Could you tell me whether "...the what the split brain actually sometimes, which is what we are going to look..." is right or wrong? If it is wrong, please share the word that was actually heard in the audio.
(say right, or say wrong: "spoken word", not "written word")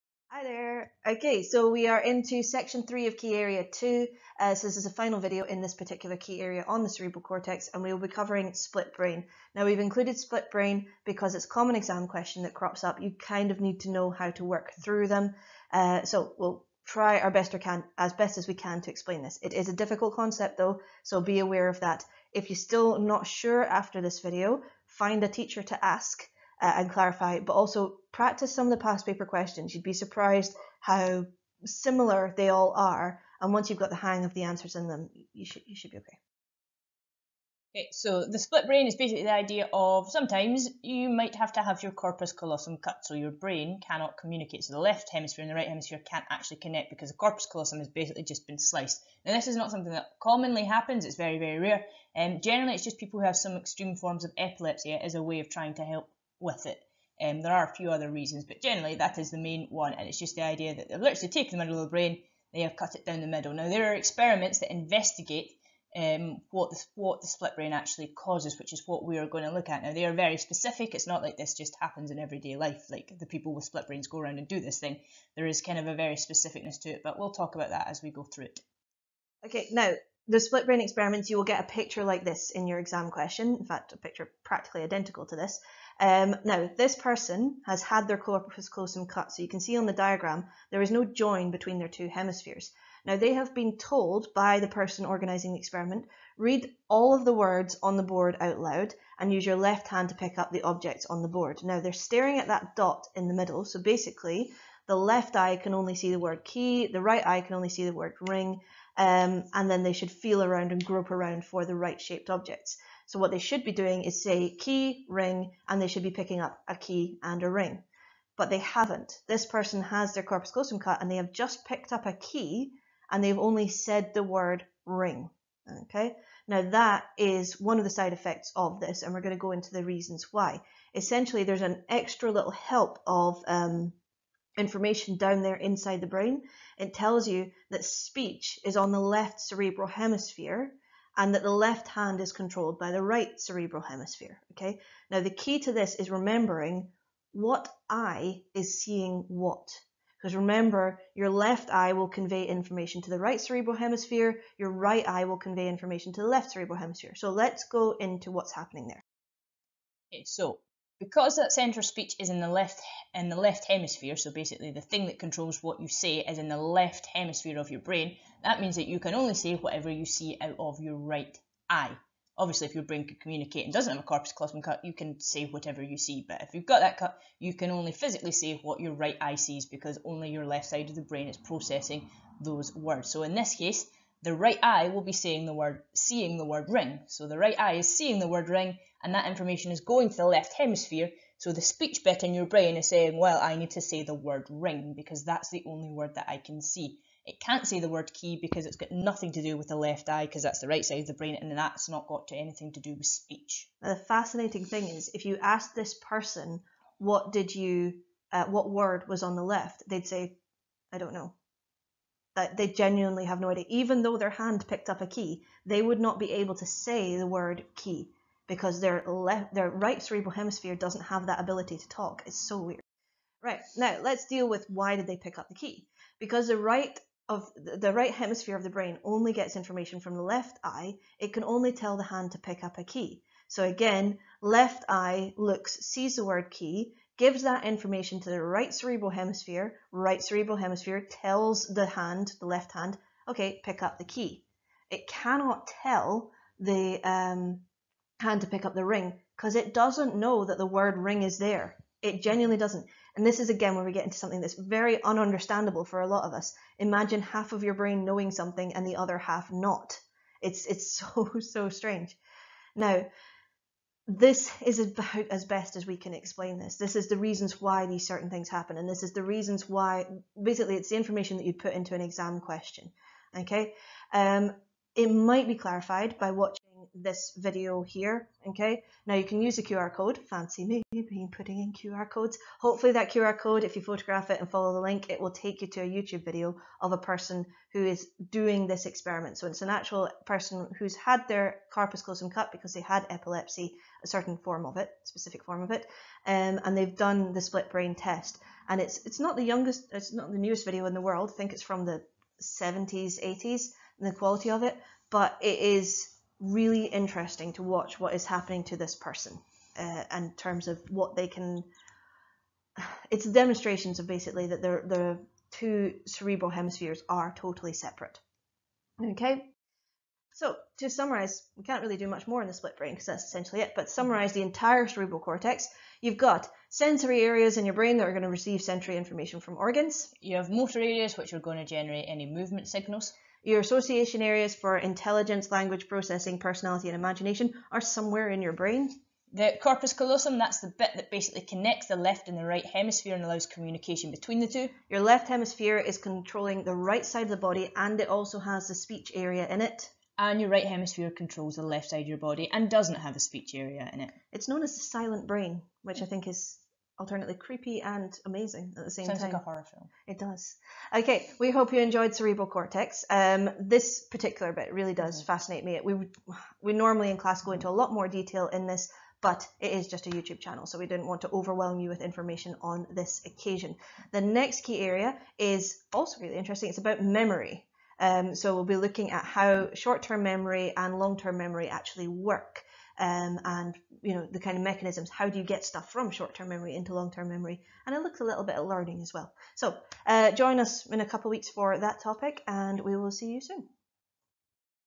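wrong: "causes", not "sometimes".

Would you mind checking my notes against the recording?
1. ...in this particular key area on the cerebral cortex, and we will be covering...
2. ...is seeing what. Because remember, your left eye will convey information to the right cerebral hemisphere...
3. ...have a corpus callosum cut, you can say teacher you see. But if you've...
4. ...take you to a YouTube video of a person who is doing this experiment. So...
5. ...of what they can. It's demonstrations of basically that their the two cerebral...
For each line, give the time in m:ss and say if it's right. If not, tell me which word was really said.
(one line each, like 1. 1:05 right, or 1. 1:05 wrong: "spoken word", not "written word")
1. 0:05 right
2. 2:28 right
3. 2:53 wrong: "whatever", not "teacher"
4. 4:45 right
5. 5:10 right.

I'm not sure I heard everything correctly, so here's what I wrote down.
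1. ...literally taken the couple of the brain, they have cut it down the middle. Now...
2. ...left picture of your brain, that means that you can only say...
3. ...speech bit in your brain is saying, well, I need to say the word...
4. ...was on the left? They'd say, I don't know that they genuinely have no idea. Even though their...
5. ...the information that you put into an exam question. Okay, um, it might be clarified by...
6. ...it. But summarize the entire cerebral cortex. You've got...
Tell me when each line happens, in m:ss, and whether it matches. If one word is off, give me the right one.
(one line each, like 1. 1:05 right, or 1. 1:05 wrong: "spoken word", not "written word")
1. 1:00 wrong: "middle", not "couple"
2. 2:46 wrong: "hemisphere", not "picture"
3. 3:11 right
4. 3:29 right
5. 4:30 right
6. 5:23 right.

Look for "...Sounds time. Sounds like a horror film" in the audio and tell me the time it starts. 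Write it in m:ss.
5:59.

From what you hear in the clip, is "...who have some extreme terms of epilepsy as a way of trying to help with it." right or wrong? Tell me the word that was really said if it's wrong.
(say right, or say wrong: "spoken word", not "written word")
wrong: "forms", not "terms".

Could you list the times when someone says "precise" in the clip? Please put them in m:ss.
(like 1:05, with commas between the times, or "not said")
not said.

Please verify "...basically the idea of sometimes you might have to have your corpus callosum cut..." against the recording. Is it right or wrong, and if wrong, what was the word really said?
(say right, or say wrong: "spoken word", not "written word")
right.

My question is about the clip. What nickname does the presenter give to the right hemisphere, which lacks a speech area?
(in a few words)
the silent brain.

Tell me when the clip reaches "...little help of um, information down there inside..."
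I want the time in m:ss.
2:12.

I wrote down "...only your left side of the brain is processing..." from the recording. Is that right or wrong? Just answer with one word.
right.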